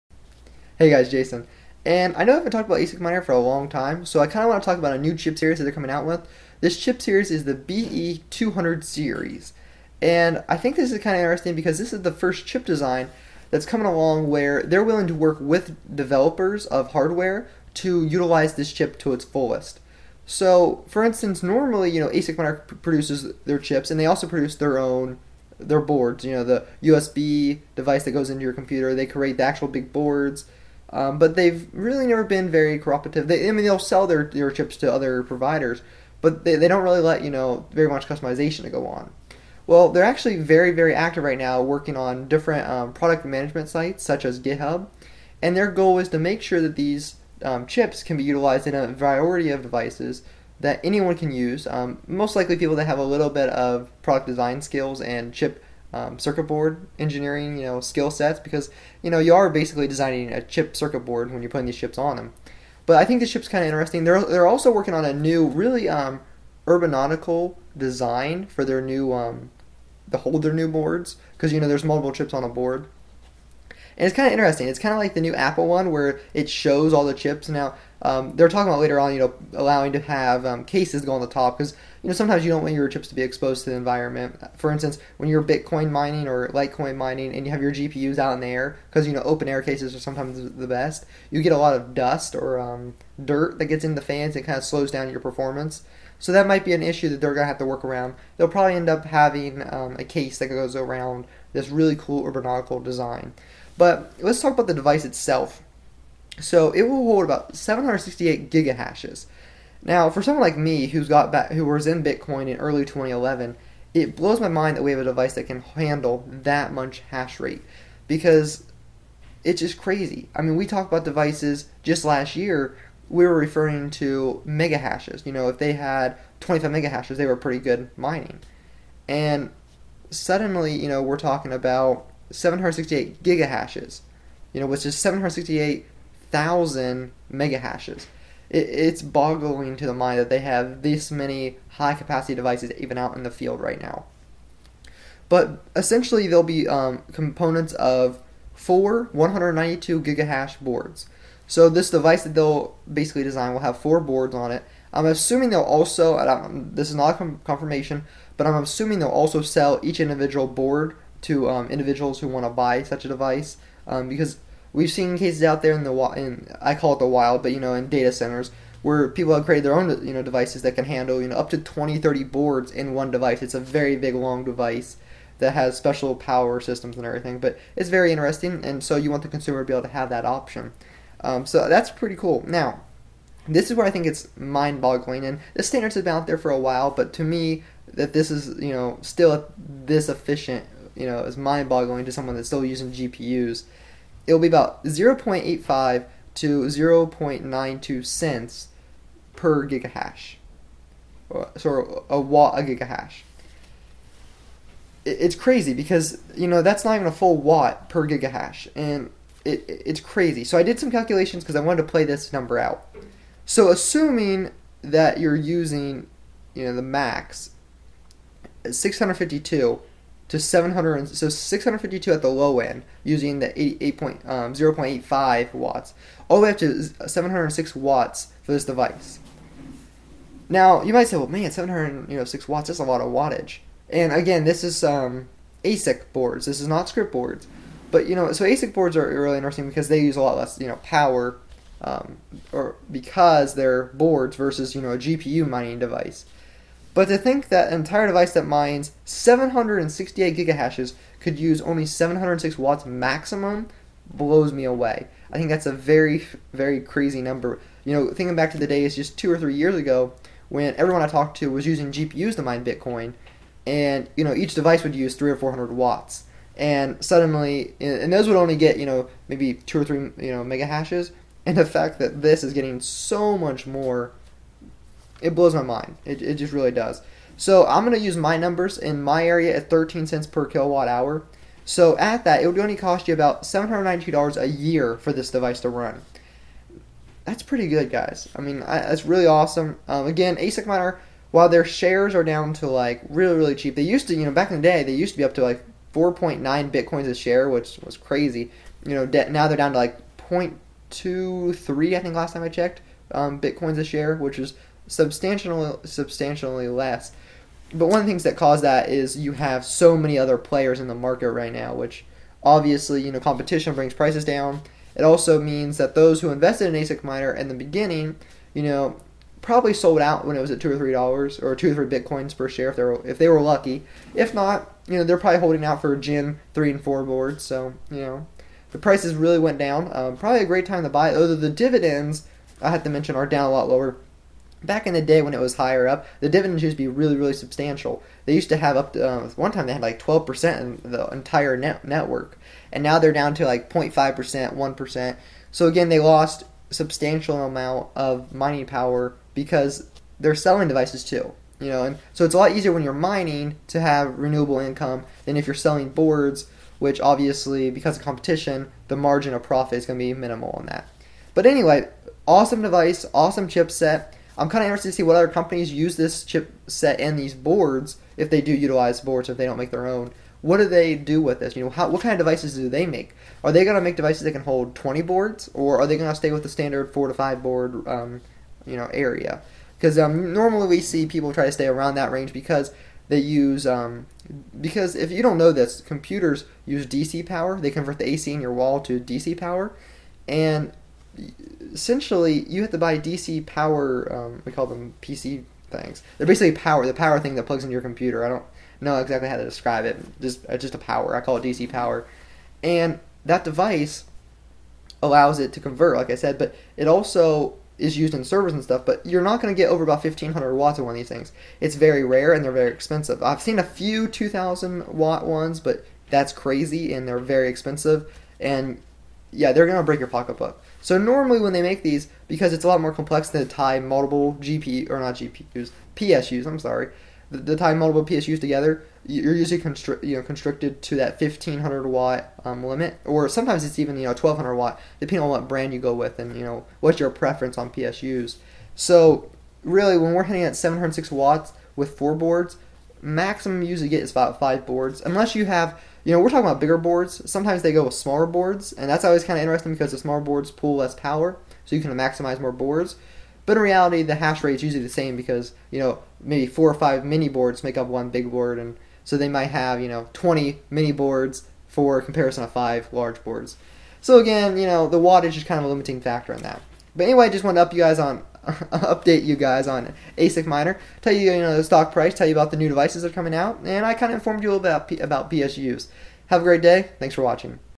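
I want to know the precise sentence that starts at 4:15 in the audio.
I think that's a very, very crazy number.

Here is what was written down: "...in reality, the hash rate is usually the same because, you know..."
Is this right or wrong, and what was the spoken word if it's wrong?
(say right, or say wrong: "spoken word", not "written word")
right.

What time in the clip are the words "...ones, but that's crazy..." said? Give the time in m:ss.
6:55.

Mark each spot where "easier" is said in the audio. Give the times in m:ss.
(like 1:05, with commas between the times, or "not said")
5:52.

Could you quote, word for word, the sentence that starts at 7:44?
So again, you know, the wattage is kind of a limiting factor on that.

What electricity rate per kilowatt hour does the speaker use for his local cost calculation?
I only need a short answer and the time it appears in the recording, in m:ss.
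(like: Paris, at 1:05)
13 cents, at 4:39.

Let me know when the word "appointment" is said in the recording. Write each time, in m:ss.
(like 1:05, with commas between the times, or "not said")
not said.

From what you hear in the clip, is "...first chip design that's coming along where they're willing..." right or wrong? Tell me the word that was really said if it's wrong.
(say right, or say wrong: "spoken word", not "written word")
right.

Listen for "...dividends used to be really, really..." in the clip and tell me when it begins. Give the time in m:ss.
5:36.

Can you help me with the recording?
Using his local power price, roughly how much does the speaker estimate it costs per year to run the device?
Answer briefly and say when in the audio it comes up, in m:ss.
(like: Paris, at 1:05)
$792, at 4:43.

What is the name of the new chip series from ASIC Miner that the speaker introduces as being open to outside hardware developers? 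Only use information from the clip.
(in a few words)
BE200.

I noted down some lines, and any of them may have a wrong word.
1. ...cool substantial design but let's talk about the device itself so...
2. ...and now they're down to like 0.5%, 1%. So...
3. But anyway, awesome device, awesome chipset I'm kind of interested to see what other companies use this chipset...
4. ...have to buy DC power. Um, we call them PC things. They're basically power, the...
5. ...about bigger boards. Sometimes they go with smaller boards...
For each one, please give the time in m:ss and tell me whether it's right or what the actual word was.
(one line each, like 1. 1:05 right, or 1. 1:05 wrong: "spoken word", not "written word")
1. 1:41 wrong: "urbanautical", not "substantial"
2. 5:42 right
3. 6:01 right
4. 6:32 right
5. 7:26 right.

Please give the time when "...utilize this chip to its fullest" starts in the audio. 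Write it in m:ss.
0:18.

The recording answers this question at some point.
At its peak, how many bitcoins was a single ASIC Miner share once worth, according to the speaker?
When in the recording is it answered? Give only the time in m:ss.
4:55.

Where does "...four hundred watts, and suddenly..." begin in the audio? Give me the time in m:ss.
4:25.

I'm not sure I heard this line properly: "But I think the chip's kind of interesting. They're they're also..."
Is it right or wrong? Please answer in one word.
right.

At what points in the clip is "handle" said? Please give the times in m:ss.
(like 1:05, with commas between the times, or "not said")
1:55, 2:50.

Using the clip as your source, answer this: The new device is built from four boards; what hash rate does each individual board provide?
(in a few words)
192 gigahash.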